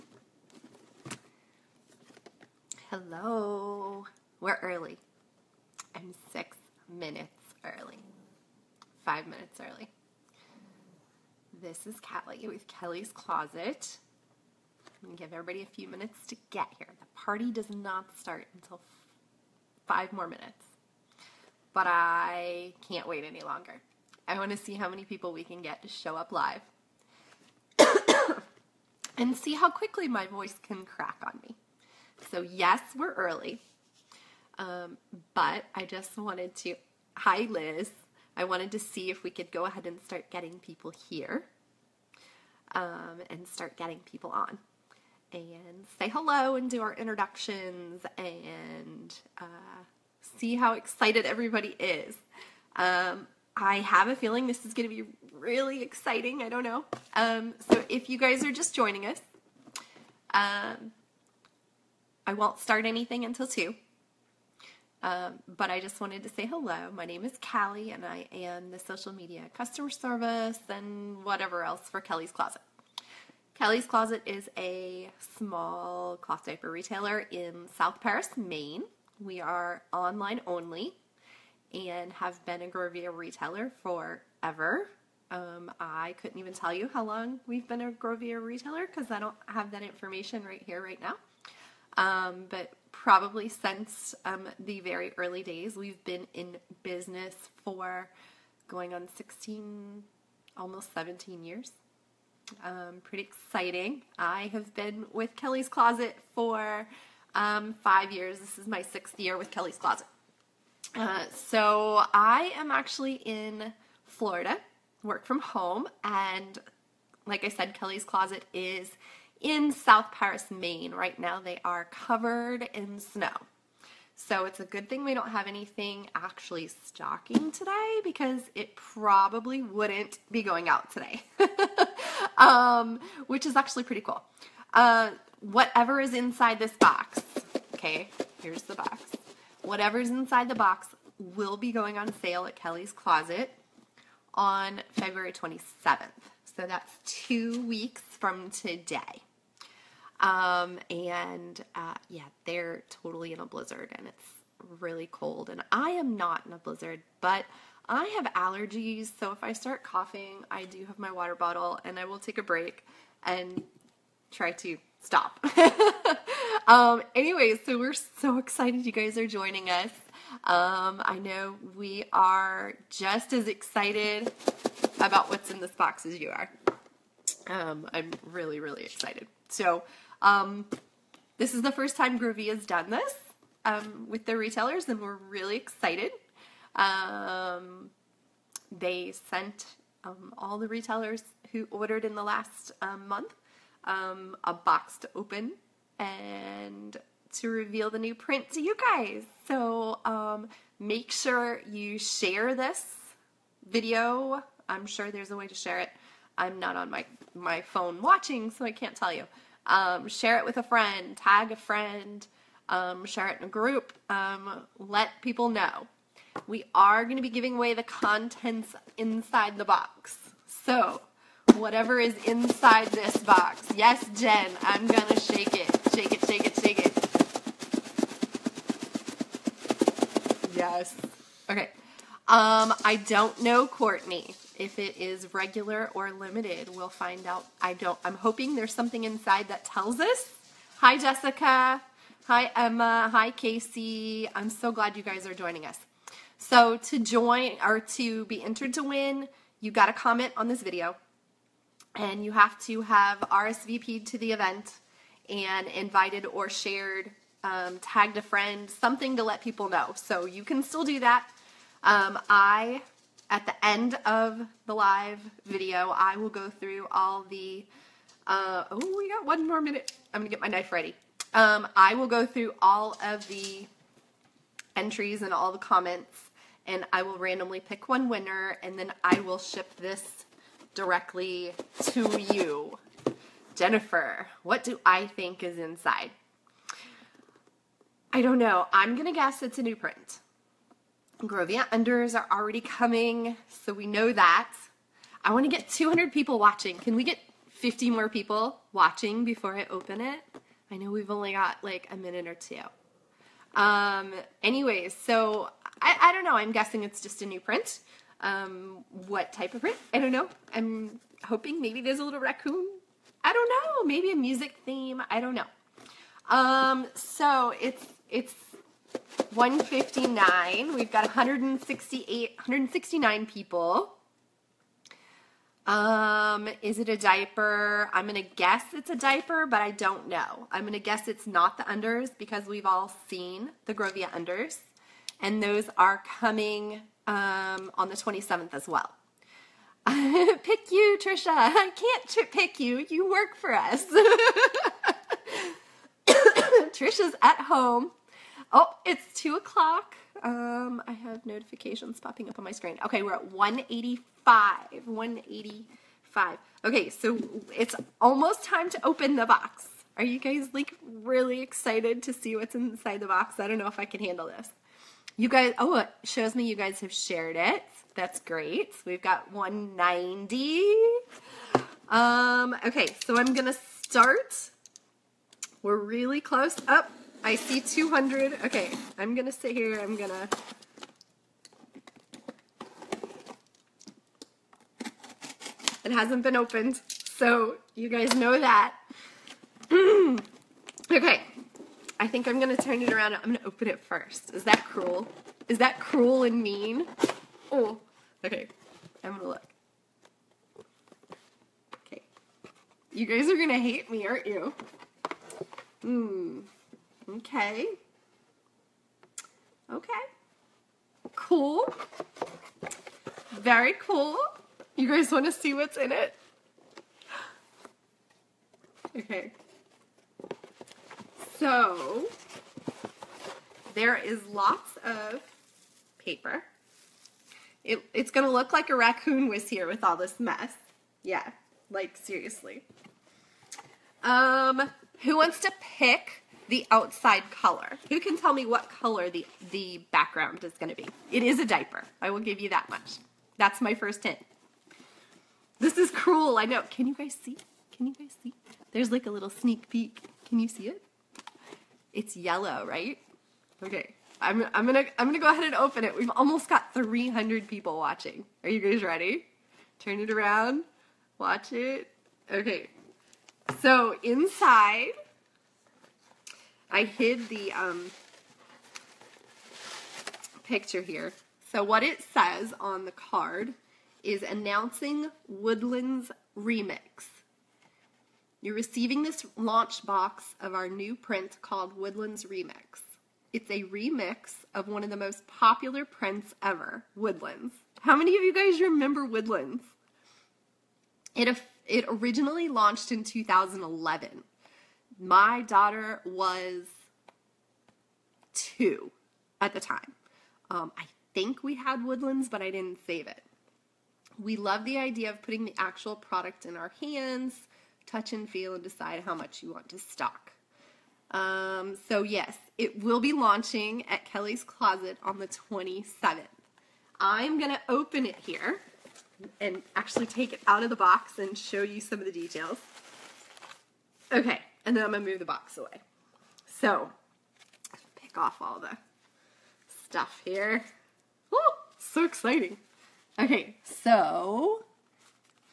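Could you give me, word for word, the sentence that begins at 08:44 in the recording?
Okay, and then I'm going to move the box away.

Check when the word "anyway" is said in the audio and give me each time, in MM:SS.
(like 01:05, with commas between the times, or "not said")
02:47, 05:04.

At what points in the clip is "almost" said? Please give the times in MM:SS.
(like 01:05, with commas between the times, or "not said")
01:40, 05:57, 07:36.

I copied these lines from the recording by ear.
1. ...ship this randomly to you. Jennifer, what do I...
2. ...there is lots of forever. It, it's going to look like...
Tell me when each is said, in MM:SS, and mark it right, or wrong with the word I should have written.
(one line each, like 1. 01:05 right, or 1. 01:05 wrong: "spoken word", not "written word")
1. 04:39 wrong: "directly", not "randomly"
2. 07:03 wrong: "paper", not "forever".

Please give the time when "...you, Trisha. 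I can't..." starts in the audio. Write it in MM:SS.
05:40.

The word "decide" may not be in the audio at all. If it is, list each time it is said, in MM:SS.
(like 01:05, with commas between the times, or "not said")
08:28.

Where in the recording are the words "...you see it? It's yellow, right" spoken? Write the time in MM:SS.
07:30.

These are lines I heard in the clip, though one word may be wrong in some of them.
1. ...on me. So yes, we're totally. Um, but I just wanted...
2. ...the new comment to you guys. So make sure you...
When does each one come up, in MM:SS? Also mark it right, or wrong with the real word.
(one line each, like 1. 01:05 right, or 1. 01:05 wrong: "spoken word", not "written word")
1. 00:31 wrong: "early", not "totally"
2. 03:17 wrong: "print", not "comment".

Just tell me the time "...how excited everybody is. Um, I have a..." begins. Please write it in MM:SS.
00:50.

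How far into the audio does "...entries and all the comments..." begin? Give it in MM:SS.
04:34.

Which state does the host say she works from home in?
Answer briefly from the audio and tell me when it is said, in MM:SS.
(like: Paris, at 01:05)
Florida, at 01:54.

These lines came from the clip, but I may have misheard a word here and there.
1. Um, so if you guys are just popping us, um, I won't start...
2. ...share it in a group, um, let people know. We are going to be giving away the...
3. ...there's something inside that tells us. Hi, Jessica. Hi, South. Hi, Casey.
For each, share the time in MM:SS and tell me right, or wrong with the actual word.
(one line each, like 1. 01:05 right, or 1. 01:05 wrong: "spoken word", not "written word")
1. 00:57 wrong: "joining", not "popping"
2. 03:33 right
3. 03:58 wrong: "Emma", not "South".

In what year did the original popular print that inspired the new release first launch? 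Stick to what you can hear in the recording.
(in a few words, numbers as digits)
2011.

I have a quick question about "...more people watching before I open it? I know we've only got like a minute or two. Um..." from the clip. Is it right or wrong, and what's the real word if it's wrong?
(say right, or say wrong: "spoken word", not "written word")
right.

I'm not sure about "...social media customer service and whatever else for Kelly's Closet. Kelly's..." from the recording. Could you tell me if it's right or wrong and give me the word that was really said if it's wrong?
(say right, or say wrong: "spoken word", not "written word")
right.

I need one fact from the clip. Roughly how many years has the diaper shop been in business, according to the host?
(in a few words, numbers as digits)
16.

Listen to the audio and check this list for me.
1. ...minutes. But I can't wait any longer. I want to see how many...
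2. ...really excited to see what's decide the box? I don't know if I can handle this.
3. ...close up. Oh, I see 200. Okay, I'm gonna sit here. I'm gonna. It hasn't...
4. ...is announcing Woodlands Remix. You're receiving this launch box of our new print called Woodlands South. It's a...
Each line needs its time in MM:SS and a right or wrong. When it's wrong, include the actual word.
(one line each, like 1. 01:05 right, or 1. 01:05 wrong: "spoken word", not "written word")
1. 00:20 right
2. 06:01 wrong: "inside", not "decide"
3. 06:16 right
4. 07:54 wrong: "Remix", not "South".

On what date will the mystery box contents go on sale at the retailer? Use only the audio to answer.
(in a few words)
February 27th.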